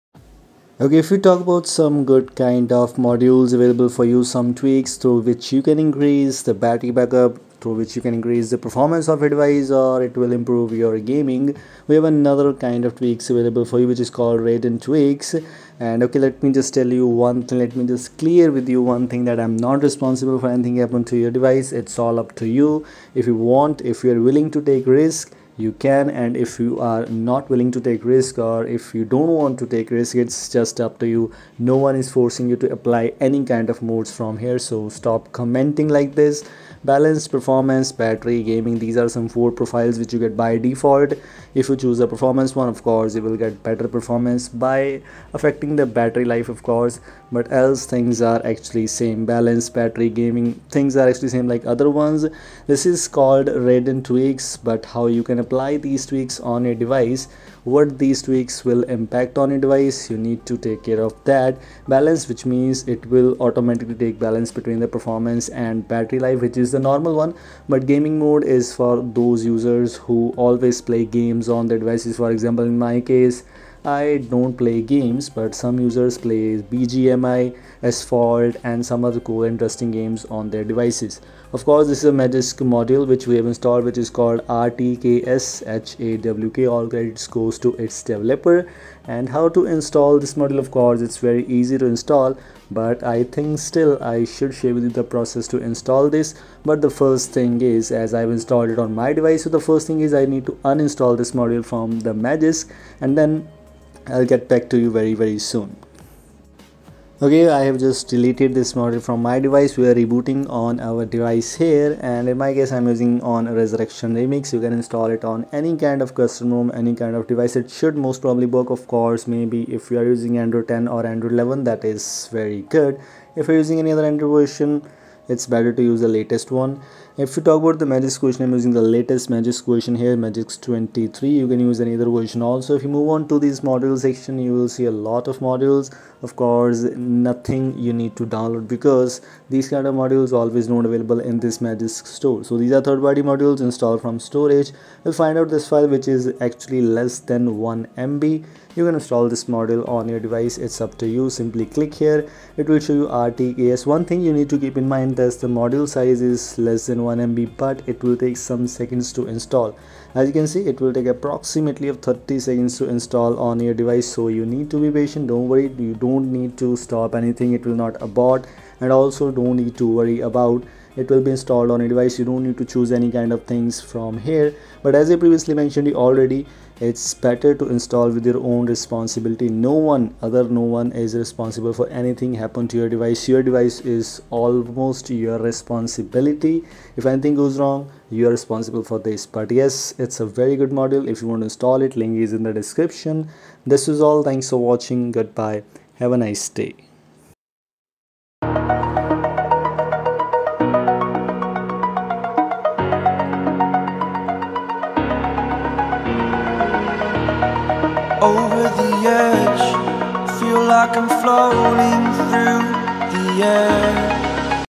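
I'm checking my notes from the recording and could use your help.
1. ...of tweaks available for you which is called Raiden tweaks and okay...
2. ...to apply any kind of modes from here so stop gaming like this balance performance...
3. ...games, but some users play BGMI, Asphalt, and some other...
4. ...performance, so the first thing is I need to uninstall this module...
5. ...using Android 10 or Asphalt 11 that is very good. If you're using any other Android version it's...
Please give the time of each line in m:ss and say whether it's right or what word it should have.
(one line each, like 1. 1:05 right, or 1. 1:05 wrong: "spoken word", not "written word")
1. 0:12 right
2. 0:32 wrong: "commenting", not "gaming"
3. 1:14 right
4. 1:39 wrong: "device", not "performance"
5. 2:00 wrong: "Android", not "Asphalt".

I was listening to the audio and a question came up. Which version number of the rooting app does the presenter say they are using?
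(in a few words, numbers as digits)
Magisk 23.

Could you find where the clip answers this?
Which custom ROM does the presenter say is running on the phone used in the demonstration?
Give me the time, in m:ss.
1:53.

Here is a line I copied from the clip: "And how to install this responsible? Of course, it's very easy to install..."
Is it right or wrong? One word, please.
wrong.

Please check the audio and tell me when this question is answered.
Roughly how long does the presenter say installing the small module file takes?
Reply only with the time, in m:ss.
2:42.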